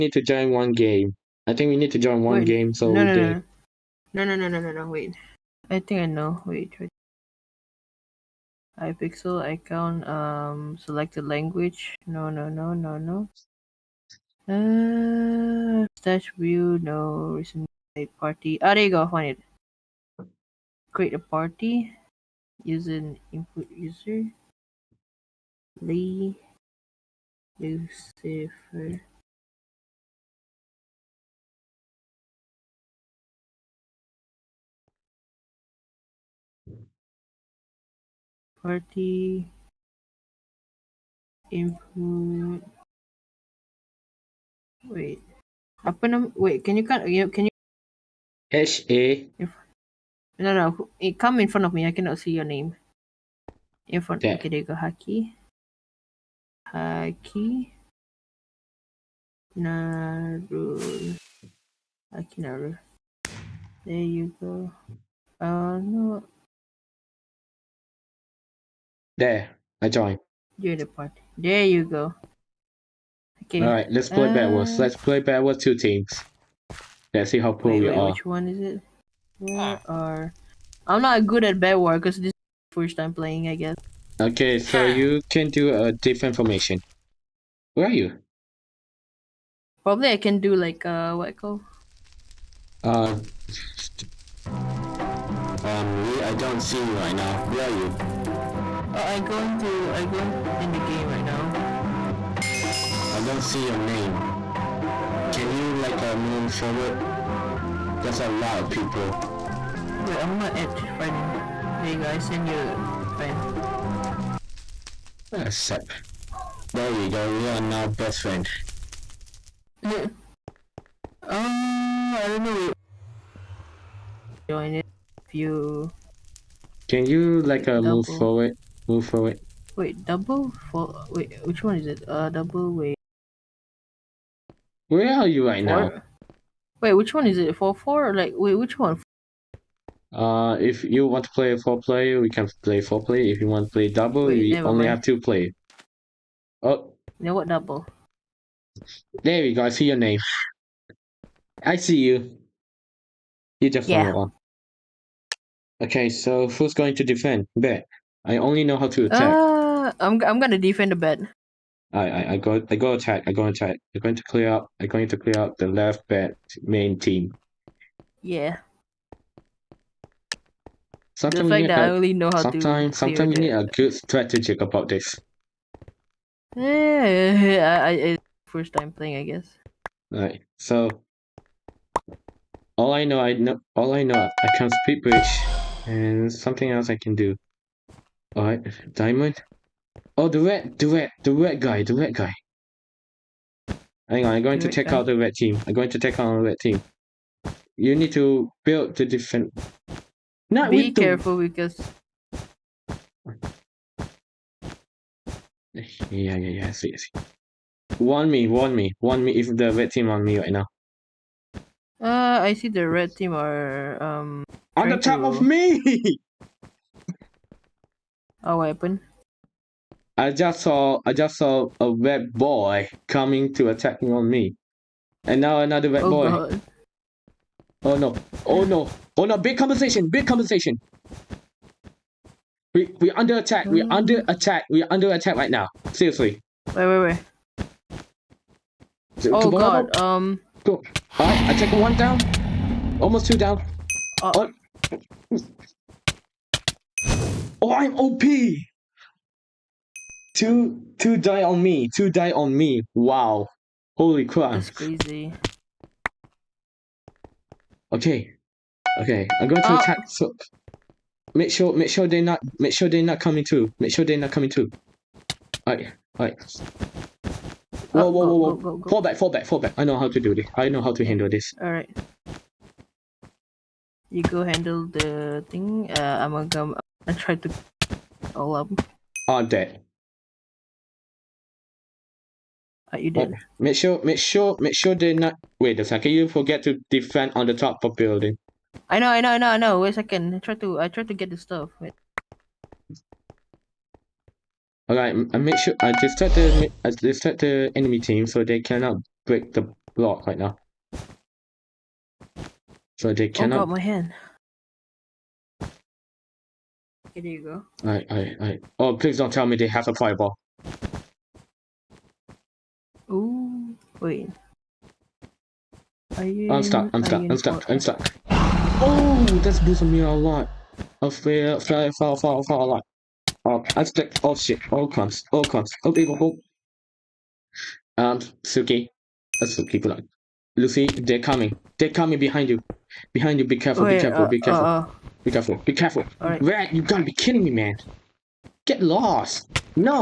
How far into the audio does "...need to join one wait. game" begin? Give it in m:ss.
0:01.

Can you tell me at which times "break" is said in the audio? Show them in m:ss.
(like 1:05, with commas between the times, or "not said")
4:59.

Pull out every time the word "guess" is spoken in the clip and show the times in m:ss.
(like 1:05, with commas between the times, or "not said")
1:23, 2:59.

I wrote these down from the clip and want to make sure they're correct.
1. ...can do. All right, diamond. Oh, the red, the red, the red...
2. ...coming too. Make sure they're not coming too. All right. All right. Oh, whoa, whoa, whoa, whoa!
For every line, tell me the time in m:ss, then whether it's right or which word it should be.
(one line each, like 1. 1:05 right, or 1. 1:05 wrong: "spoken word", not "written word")
1. 3:07 right
2. 4:23 right.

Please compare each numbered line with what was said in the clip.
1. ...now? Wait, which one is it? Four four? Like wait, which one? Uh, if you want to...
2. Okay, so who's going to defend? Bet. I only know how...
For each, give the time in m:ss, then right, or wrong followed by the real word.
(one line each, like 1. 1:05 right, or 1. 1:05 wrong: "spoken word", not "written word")
1. 2:15 right
2. 2:35 right.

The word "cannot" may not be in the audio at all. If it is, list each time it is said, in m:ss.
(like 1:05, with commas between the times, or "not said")
0:51, 4:58, 5:03.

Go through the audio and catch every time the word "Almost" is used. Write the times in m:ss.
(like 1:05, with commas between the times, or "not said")
4:03.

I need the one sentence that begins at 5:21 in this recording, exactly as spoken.
I feel, fly, fall, fall, fall a lot.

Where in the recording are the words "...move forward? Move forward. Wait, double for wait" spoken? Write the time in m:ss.
2:07.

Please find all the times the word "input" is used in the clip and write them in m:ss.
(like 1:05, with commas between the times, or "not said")
0:23, 0:41.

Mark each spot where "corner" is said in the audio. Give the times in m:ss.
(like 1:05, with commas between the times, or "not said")
not said.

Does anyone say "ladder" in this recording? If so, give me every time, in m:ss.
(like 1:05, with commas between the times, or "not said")
not said.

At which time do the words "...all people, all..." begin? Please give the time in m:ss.
5:25.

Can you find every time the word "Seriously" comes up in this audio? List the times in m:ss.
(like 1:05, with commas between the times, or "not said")
3:55.